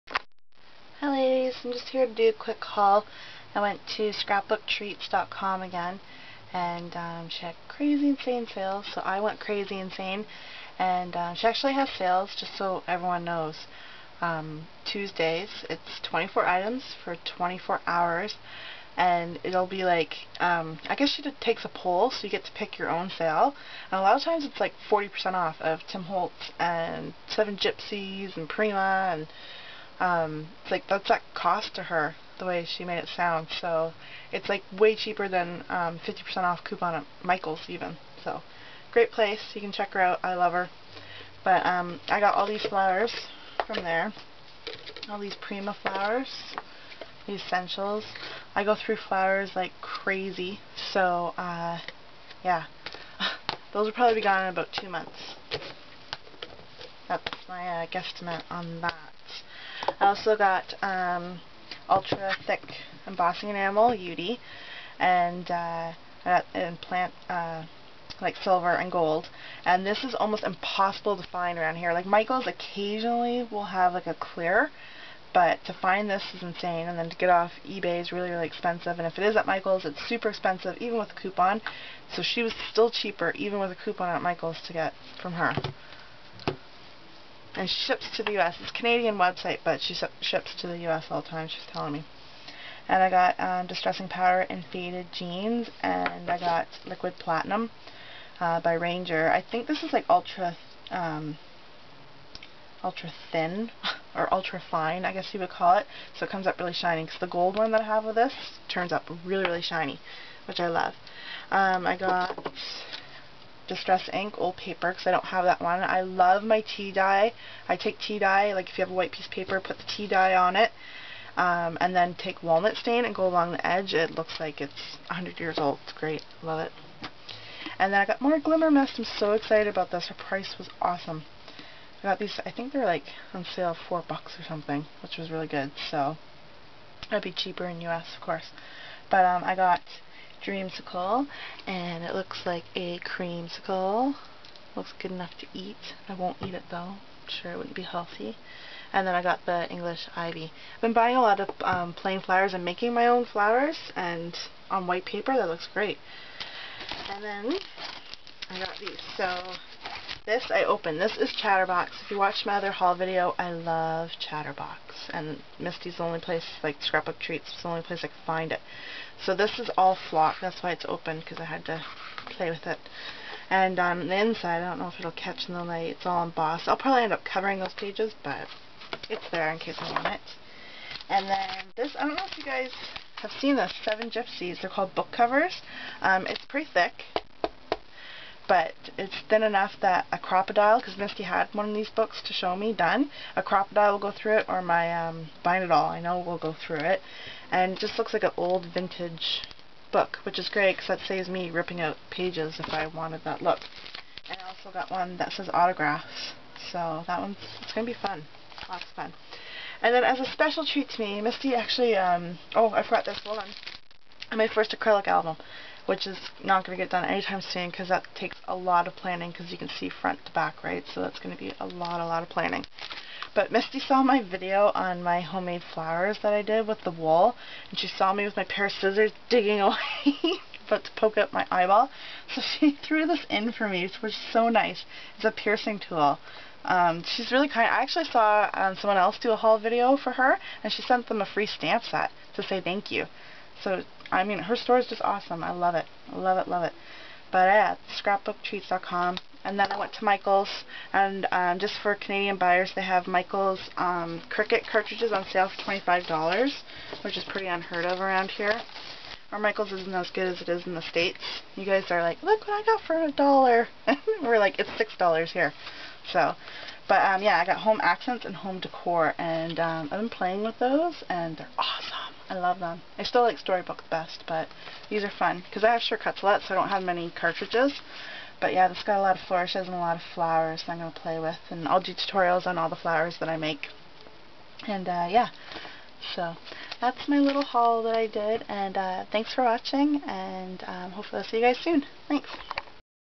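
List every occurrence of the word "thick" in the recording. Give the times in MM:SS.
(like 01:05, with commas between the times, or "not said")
01:02, 03:06.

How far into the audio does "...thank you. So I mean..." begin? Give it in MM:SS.
04:02.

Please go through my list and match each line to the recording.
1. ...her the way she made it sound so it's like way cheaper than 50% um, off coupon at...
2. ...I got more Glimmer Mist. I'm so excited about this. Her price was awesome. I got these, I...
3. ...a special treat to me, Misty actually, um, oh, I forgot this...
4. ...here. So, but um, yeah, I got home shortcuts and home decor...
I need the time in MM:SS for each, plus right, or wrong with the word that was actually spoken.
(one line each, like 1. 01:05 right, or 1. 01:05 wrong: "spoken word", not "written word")
1. 00:31 right
2. 02:08 right
3. 03:30 right
4. 04:25 wrong: "accents", not "shortcuts".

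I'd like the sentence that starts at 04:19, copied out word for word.
Our Michael's isn't as good as it is in the States.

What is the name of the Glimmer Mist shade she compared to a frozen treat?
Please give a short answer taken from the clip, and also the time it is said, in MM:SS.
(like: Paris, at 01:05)
Dreamsicle, at 02:20.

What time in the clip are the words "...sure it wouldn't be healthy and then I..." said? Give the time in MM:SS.
02:27.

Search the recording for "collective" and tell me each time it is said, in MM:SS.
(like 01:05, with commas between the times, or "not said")
not said.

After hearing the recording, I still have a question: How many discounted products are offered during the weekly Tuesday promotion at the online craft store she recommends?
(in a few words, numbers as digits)
24.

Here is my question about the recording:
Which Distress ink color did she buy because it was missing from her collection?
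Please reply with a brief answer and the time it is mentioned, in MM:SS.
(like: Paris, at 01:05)
Old paper, at 01:54.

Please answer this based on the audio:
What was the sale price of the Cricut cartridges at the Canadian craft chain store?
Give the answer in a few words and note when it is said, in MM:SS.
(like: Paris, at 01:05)
$25, at 04:15.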